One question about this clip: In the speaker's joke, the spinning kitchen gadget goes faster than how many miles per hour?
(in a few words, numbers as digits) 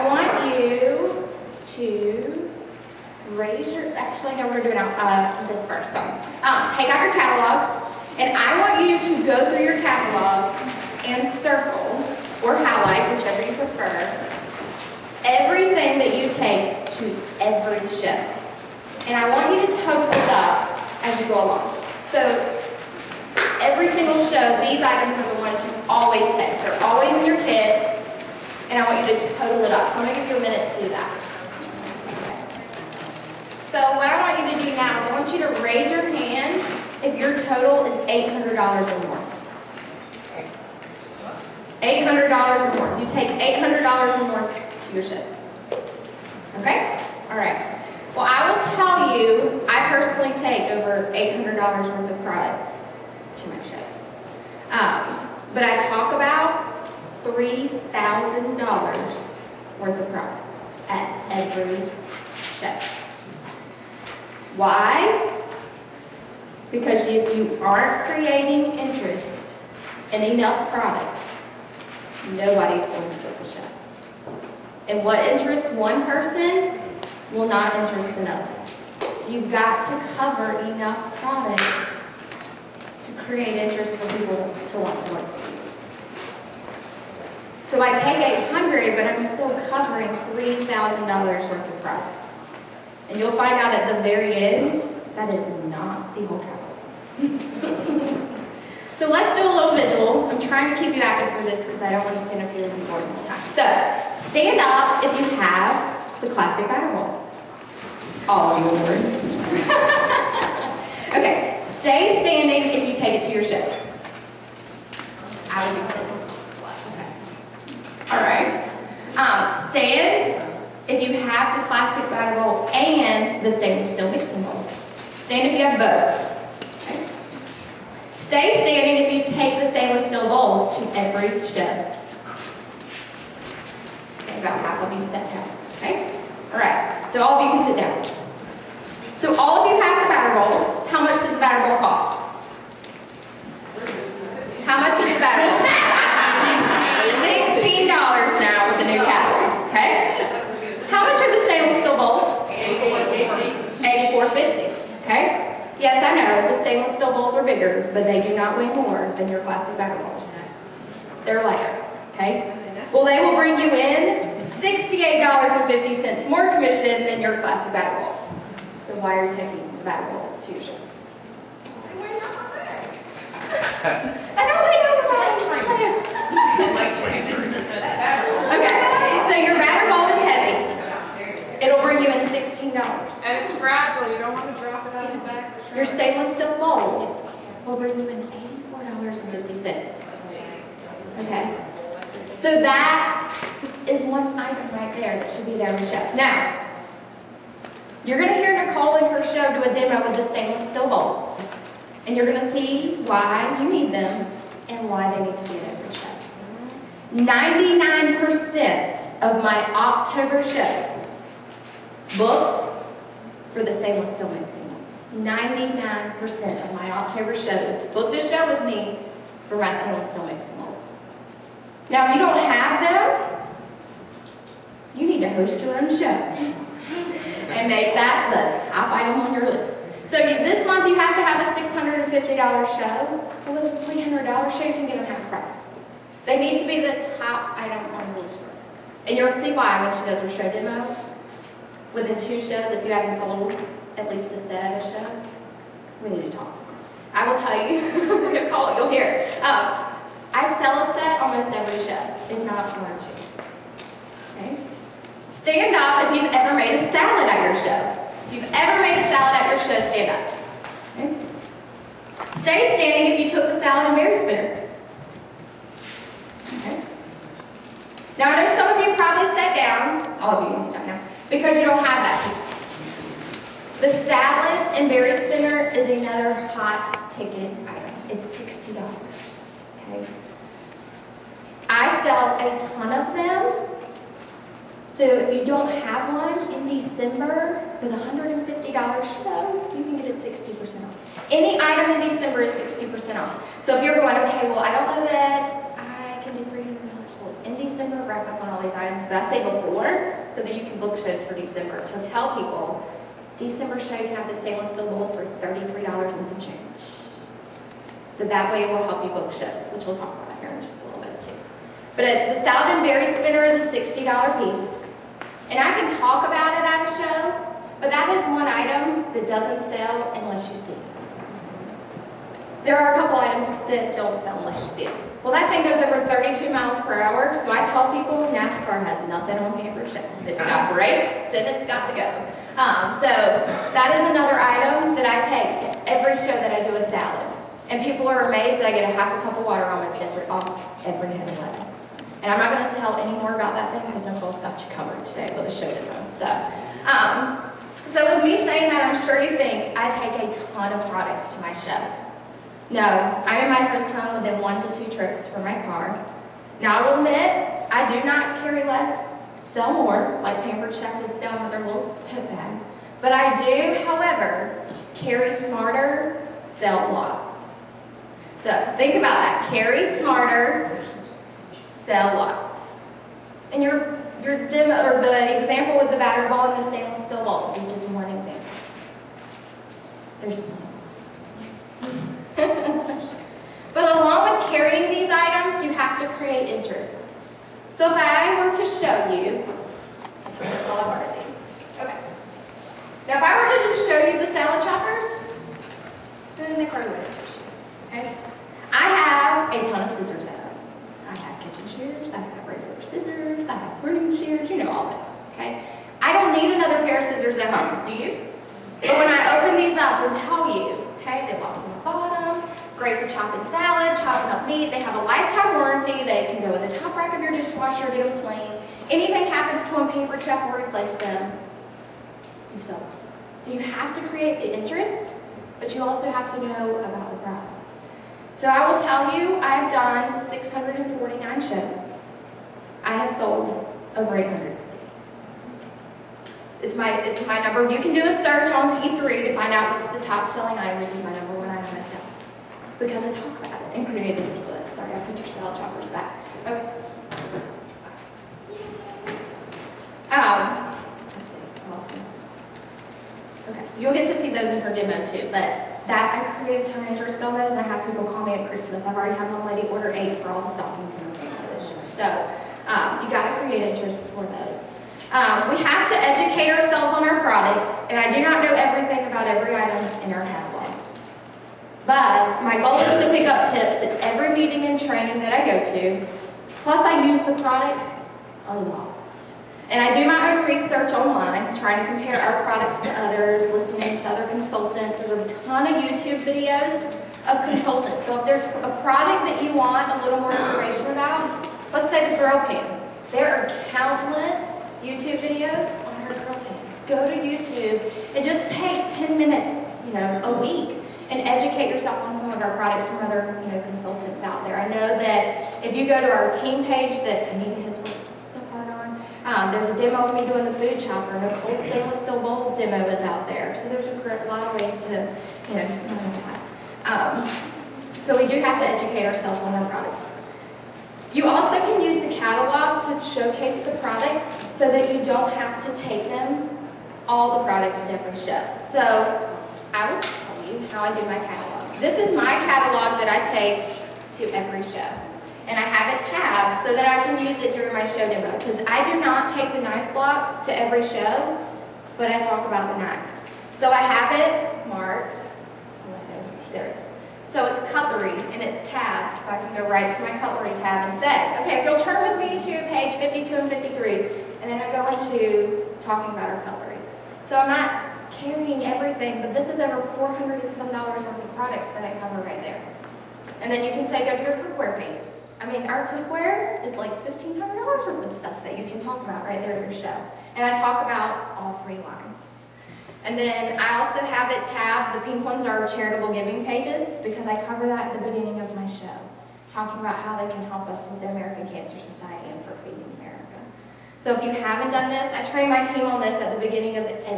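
32.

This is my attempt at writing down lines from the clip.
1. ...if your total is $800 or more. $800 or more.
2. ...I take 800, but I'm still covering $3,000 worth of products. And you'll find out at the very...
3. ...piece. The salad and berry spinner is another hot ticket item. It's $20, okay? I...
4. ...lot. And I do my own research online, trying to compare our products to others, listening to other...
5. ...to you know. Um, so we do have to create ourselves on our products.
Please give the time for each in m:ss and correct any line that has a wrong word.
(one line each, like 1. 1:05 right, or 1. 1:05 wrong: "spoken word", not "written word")
1. 0:37 right
2. 1:27 right
3. 4:32 wrong: "60", not "20"
4. 7:58 right
5. 8:34 wrong: "educate", not "create".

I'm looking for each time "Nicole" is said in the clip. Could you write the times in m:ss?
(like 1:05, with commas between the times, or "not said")
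3:18, 5:44, 8:31.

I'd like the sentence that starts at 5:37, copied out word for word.
And people are amazed that I get a half a cup of water almost every, off every head of lettuce.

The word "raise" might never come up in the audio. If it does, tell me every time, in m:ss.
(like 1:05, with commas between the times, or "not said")
0:03, 0:35.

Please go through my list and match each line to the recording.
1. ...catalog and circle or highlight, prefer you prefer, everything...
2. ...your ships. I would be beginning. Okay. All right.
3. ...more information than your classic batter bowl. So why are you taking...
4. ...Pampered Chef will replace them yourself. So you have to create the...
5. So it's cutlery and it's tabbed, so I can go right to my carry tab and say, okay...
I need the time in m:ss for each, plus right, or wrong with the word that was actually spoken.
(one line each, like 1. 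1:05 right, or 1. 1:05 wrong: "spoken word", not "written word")
1. 0:09 wrong: "whichever", not "prefer"
2. 1:53 wrong: "sitting", not "beginning"
3. 2:46 wrong: "commission", not "information"
4. 6:59 right
5. 9:07 wrong: "cutlery", not "carry".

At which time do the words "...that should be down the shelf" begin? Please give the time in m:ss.
3:15.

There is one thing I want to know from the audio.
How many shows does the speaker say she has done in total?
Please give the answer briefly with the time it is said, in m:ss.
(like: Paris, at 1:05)
649, at 7:10.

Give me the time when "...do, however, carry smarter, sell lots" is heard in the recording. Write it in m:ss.
6:03.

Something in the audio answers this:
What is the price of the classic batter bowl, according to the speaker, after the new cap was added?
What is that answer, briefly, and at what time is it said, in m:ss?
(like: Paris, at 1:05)
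$16, at 2:27.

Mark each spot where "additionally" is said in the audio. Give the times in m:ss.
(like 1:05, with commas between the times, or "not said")
not said.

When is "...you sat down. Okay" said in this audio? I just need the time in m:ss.
2:14.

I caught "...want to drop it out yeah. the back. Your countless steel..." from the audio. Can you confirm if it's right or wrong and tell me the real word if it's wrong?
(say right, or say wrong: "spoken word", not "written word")
wrong: "stainless", not "countless".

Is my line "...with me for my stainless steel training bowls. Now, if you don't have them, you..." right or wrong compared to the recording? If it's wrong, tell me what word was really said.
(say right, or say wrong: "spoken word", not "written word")
wrong: "mixing", not "training".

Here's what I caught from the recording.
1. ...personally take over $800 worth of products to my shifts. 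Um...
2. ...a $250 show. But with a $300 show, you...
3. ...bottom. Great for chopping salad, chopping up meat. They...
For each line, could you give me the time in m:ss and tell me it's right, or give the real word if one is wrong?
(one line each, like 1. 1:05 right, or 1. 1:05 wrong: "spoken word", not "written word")
1. 0:49 right
2. 3:51 wrong: "650", not "250"
3. 6:51 right.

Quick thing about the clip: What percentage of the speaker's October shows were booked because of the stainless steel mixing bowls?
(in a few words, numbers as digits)
99%.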